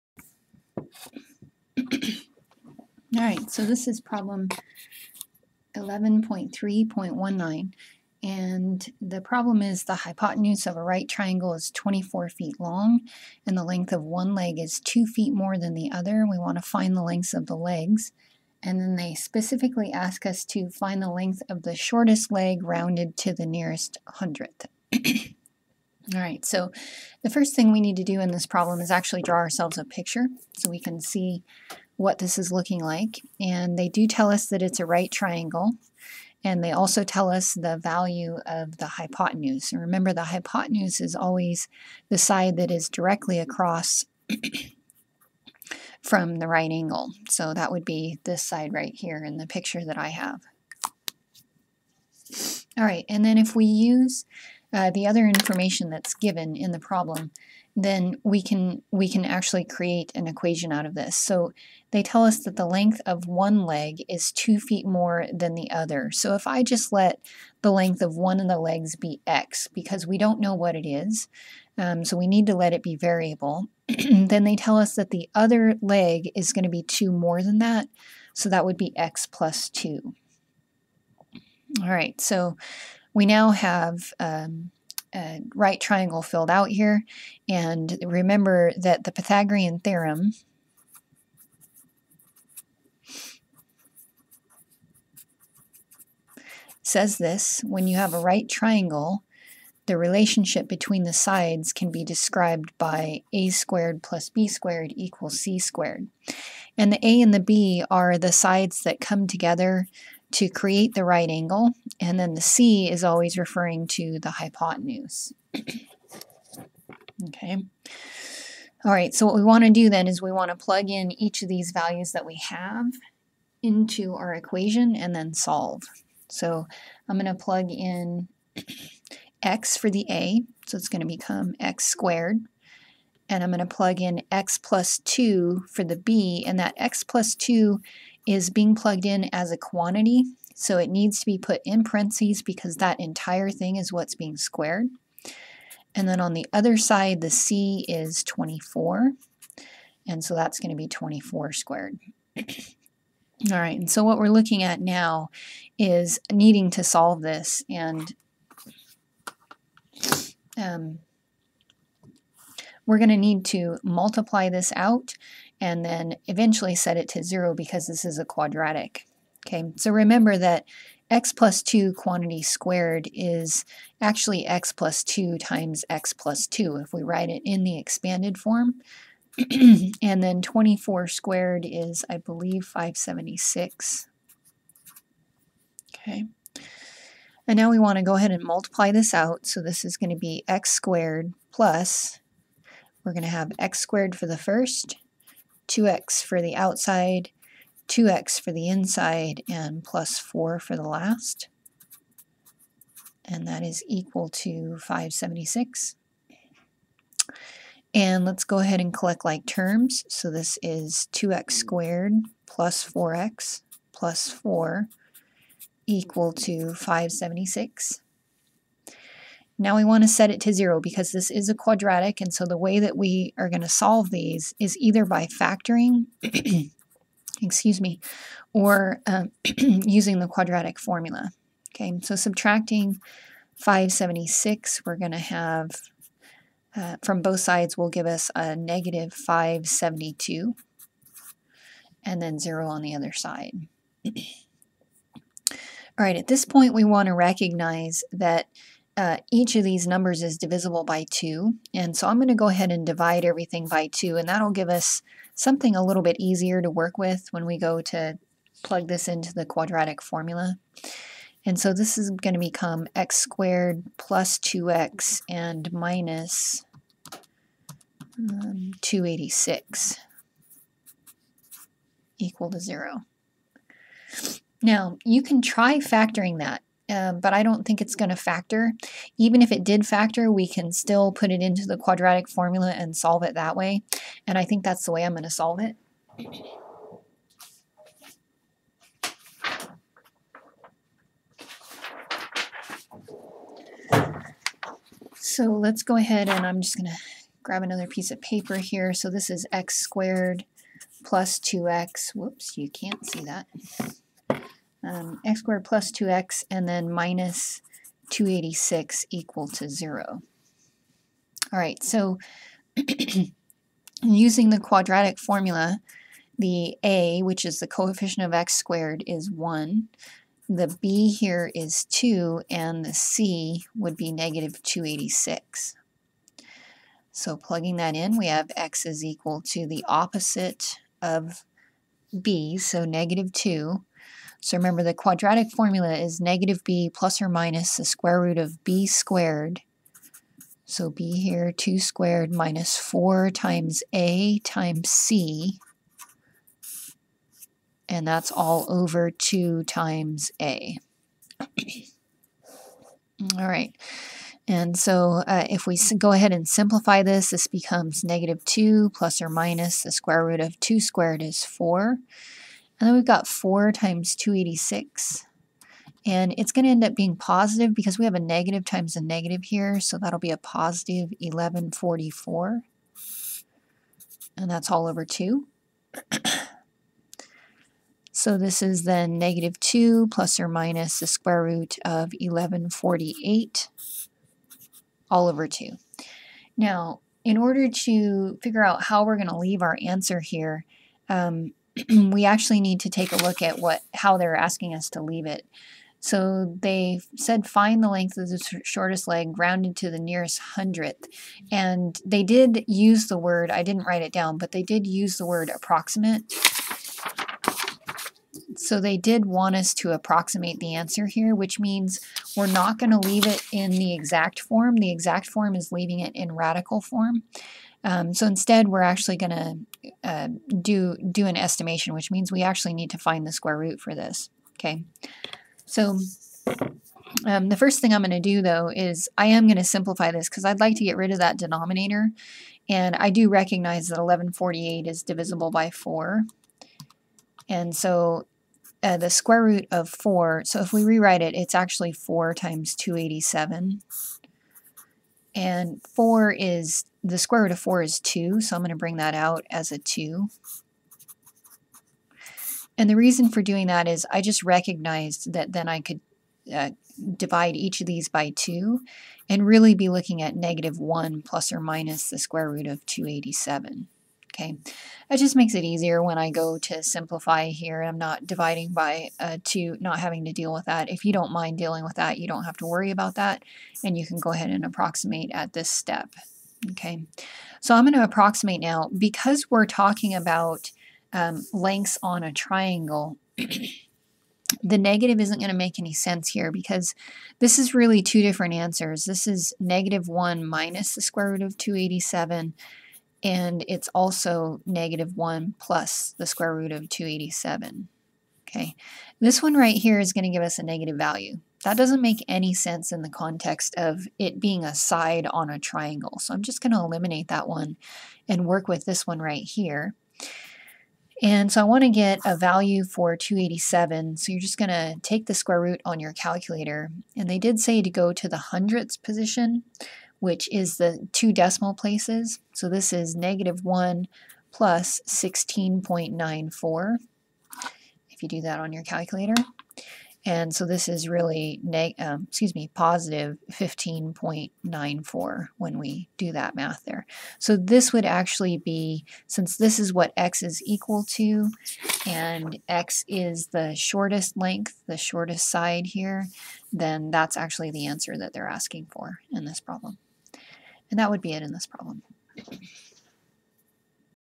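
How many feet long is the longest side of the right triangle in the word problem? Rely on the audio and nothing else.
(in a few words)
24 feet.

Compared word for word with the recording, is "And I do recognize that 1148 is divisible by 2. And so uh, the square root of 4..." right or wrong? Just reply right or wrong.
wrong.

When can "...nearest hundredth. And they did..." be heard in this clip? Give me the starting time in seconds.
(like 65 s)
399 s.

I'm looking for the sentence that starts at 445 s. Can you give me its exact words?
And 4 is, the square root of 4 is 2, so I'm going to bring that out as a 2.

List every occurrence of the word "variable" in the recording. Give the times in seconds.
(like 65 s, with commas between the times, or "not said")
72 s.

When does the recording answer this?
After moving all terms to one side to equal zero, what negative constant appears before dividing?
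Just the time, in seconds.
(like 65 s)
238 s.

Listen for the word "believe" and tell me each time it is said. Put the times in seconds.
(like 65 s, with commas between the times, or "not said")
182 s.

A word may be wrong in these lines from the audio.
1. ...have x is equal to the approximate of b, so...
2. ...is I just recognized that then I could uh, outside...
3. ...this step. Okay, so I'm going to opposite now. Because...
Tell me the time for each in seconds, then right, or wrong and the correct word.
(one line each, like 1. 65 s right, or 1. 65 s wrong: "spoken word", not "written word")
1. 328 s wrong: "opposite", not "approximate"
2. 453 s wrong: "divide", not "outside"
3. 475 s wrong: "approximate", not "opposite".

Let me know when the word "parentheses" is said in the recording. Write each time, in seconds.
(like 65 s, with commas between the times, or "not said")
141 s.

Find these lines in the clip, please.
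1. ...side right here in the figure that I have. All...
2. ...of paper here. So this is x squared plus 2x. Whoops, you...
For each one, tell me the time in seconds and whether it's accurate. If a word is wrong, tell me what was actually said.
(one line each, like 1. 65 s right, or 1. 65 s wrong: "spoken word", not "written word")
1. 48 s wrong: "picture", not "figure"
2. 298 s right.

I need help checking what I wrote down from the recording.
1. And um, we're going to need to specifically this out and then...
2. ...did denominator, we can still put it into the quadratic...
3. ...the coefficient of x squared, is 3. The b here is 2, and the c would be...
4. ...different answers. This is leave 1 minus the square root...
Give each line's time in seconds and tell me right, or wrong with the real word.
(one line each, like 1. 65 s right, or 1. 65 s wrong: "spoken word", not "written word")
1. 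157 s wrong: "multiply", not "specifically"
2. 279 s wrong: "factor", not "denominator"
3. 317 s wrong: "1", not "3"
4. 488 s wrong: "negative", not "leave".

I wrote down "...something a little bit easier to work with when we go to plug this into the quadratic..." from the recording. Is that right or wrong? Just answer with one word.
right.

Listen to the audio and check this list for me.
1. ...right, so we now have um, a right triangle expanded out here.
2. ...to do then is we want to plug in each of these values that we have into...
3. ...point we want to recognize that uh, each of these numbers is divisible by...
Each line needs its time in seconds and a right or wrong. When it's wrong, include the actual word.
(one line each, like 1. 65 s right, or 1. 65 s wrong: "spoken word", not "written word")
1. 81 s wrong: "filled", not "expanded"
2. 119 s right
3. 246 s right.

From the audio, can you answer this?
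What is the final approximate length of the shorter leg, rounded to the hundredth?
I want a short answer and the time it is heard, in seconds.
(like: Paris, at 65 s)
15.94, at 533 s.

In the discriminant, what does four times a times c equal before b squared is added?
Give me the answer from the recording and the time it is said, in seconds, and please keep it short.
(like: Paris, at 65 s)
1144, at 371 s.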